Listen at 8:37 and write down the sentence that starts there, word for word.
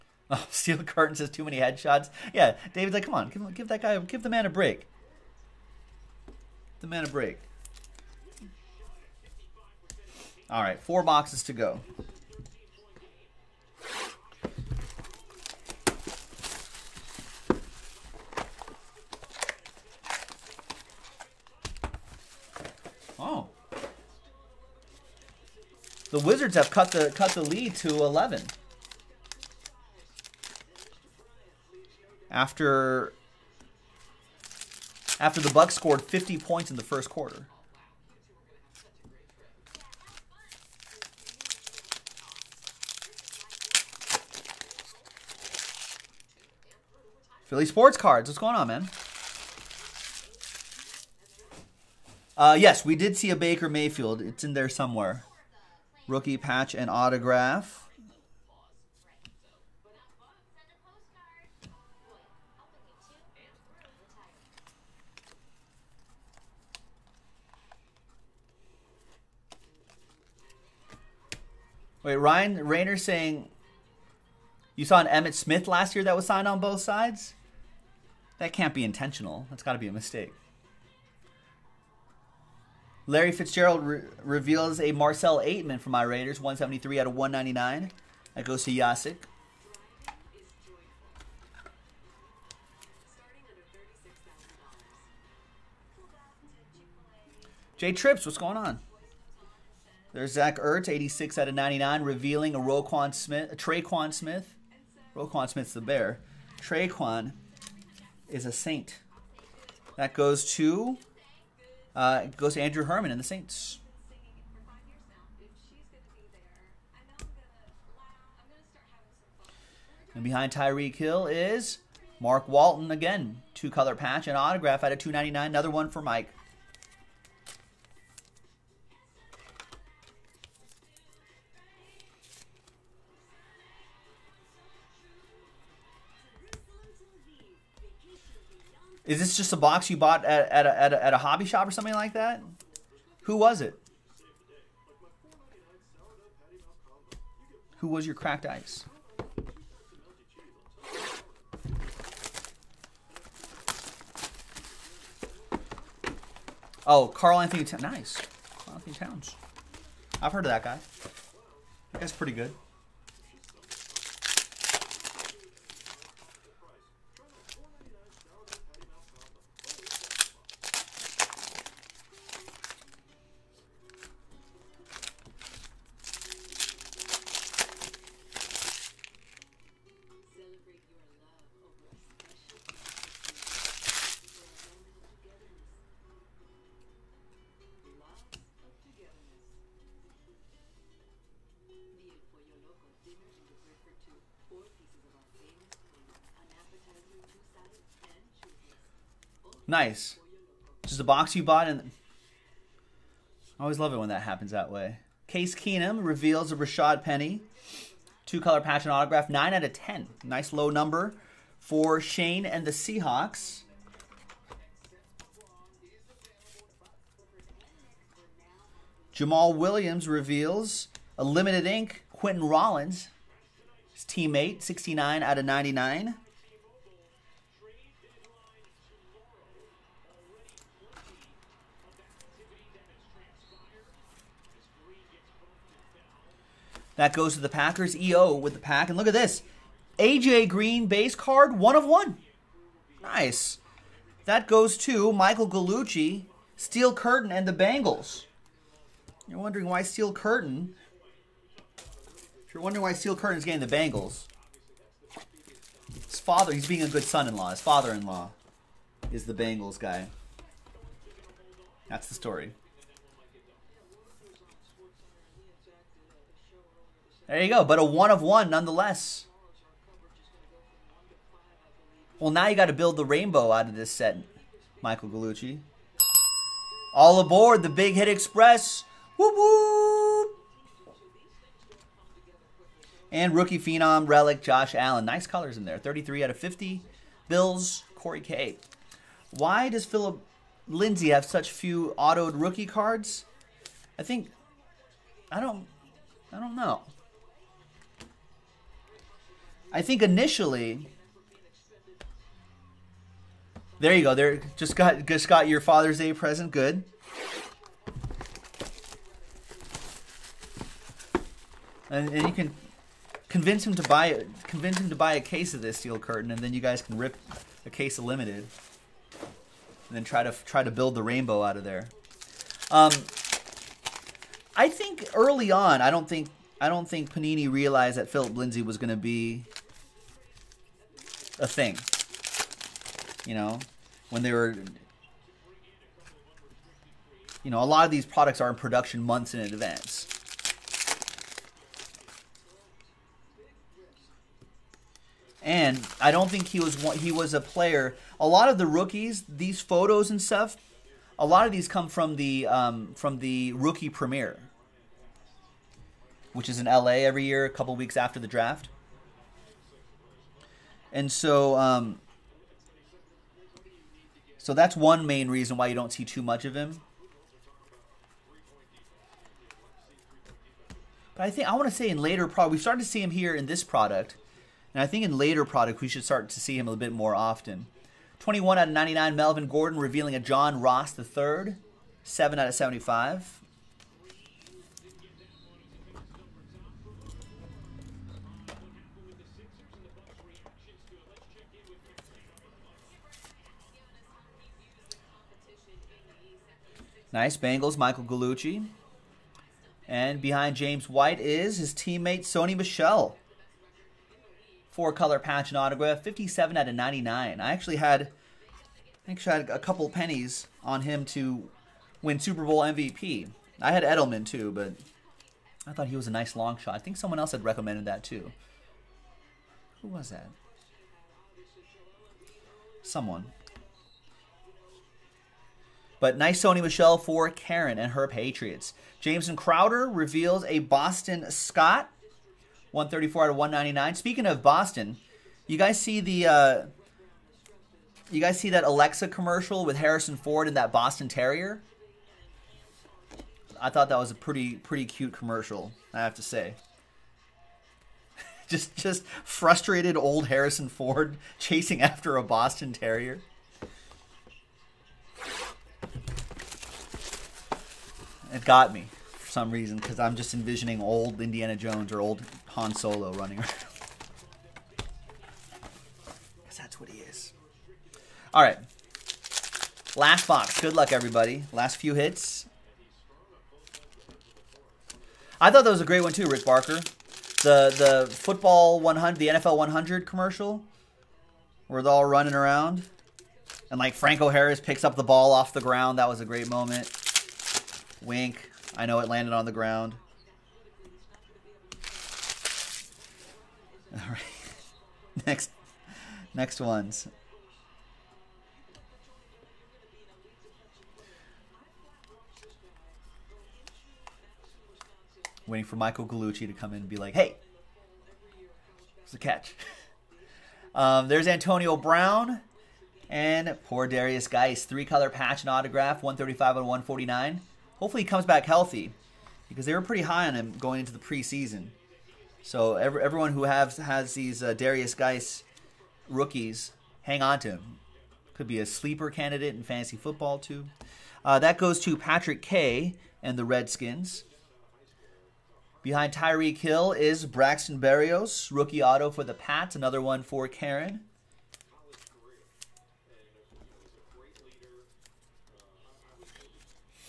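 Hopefully he comes back healthy because they were pretty high on him going into the preseason.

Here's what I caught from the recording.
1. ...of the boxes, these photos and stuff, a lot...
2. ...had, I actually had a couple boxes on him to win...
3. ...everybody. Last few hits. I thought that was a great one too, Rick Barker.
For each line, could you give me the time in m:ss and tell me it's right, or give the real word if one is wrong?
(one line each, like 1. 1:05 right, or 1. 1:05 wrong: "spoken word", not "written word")
1. 5:48 wrong: "rookies", not "boxes"
2. 6:47 wrong: "pennies", not "boxes"
3. 7:50 right.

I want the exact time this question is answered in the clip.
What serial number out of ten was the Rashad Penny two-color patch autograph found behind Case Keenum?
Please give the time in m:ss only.
3:29.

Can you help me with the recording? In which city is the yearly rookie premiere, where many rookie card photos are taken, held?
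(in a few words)
LA.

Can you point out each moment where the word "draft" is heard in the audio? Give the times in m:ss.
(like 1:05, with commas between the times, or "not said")
5:58.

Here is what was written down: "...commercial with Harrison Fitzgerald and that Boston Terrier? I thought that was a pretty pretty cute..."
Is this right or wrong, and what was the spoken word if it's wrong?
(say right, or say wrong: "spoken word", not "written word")
wrong: "Ford", not "Fitzgerald".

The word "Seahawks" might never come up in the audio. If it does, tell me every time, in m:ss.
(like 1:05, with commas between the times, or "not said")
3:32.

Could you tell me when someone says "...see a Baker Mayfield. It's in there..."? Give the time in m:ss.
0:53.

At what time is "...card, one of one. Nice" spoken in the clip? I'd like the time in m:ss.
4:01.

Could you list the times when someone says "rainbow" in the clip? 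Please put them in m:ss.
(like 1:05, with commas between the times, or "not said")
4:33, 5:21.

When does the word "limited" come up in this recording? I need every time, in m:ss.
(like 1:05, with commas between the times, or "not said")
3:41, 5:18.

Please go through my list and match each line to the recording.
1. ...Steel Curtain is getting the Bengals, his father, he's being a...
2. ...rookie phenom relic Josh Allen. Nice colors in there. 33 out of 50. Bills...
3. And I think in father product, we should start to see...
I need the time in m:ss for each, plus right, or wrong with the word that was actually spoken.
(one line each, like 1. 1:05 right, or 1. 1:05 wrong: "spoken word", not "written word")
1. 4:12 right
2. 4:43 right
3. 6:14 wrong: "later", not "father".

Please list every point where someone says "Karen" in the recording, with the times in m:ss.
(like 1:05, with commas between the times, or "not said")
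7:07, 9:00.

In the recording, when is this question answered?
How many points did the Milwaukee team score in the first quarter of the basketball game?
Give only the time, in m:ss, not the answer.
0:36.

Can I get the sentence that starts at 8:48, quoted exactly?
Could be a sleeper candidate in fantasy football too.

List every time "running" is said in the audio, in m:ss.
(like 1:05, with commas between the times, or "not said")
7:43, 8:02.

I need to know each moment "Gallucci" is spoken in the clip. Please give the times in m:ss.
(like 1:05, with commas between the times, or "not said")
4:05, 4:35, 6:38, 8:26.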